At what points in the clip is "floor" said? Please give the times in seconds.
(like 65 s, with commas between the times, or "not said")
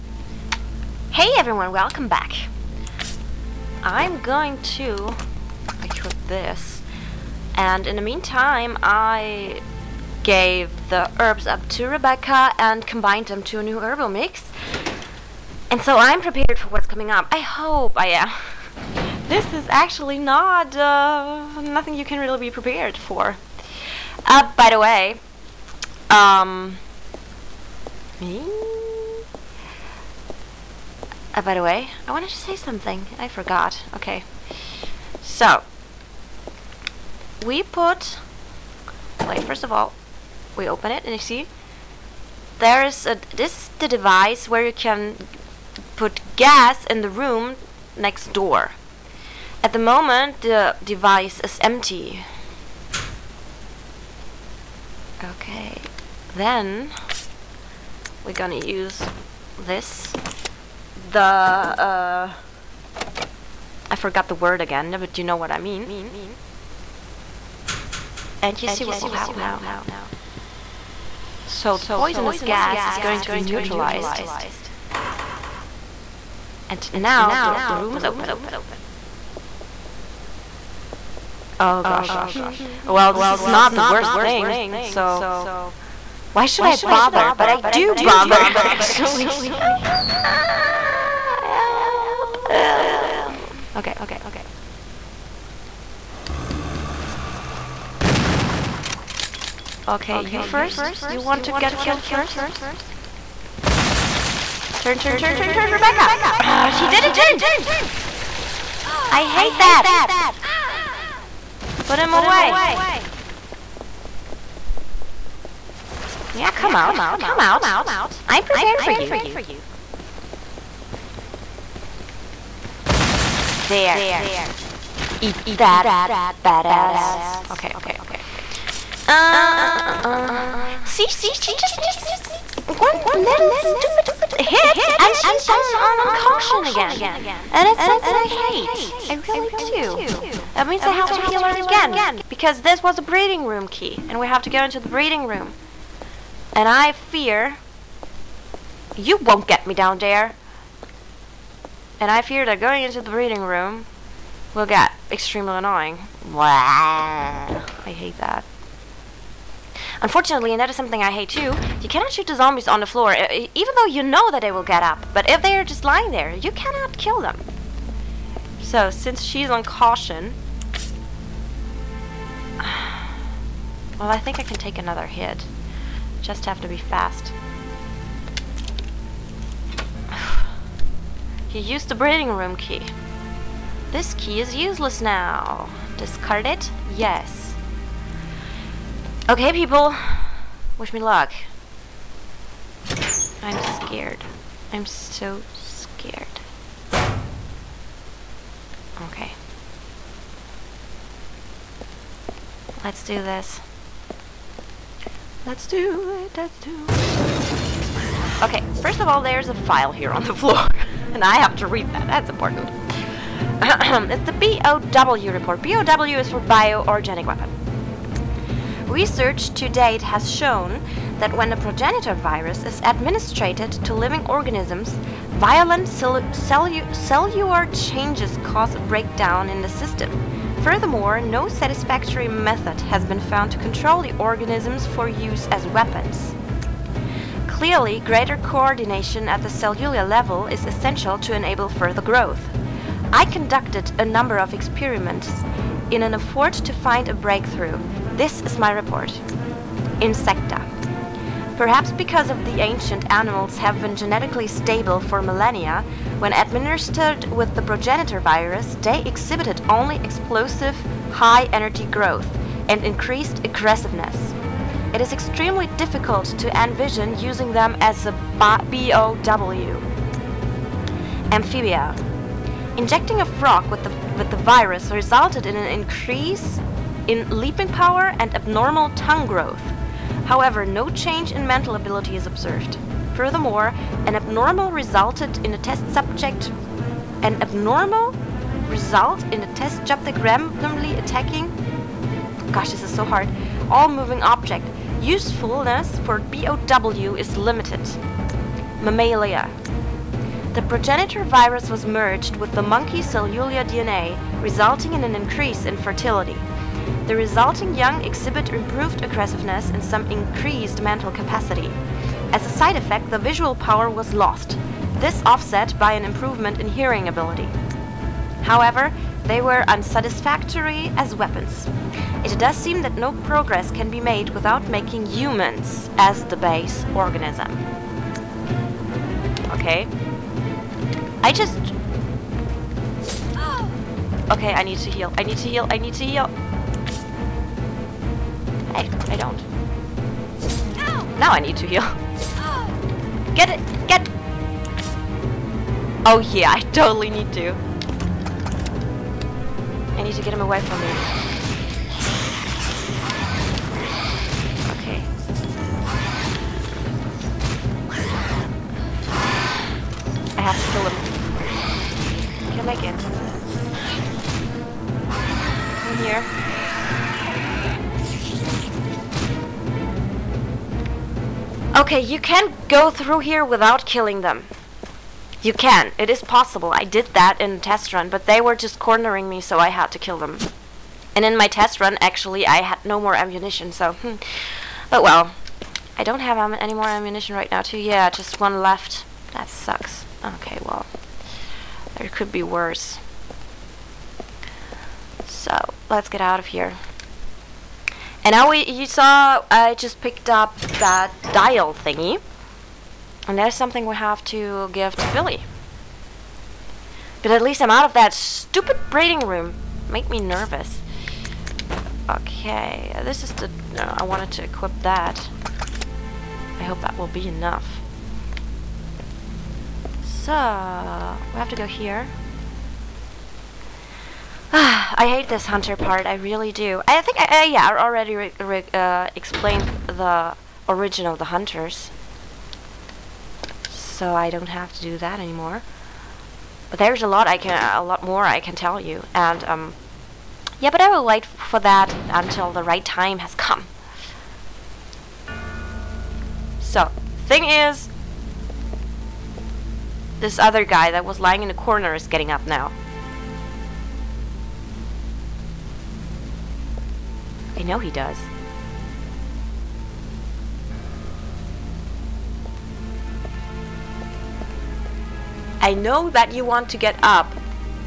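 162 s, 210 s.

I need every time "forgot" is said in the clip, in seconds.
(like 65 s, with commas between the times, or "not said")
33 s, 63 s.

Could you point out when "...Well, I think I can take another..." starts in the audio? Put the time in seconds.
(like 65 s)
173 s.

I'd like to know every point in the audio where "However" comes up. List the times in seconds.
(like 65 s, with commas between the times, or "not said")
280 s, 318 s.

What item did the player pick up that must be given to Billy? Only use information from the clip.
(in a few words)
dial thingy.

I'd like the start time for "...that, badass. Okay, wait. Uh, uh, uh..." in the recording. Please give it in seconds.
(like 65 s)
125 s.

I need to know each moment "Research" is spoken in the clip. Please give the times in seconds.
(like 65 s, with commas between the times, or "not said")
218 s.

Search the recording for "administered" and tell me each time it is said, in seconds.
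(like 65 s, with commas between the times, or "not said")
222 s, 256 s.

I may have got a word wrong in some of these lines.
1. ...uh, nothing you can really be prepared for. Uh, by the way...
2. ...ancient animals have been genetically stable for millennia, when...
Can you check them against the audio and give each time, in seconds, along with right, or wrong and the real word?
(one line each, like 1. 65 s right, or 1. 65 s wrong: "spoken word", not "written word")
1. 20 s right
2. 252 s right.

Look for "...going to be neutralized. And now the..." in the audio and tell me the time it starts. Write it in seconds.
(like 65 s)
72 s.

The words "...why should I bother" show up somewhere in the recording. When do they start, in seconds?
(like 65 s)
86 s.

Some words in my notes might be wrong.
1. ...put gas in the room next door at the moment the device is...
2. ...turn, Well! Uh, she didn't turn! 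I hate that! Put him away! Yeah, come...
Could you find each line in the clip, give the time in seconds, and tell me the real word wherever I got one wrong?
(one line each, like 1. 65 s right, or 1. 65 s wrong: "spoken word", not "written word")
1. 45 s right
2. 105 s wrong: "Rebecca", not "Well".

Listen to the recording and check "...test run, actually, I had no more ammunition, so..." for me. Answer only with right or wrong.
right.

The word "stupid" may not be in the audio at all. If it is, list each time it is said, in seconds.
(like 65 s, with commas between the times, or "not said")
133 s, 408 s.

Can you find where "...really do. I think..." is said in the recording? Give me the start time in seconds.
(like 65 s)
426 s.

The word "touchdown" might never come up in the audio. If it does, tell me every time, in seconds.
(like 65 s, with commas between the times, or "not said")
not said.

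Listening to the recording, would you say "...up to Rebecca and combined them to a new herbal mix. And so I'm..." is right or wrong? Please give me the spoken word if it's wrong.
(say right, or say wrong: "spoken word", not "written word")
right.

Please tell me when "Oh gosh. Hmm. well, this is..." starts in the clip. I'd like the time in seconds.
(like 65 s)
81 s.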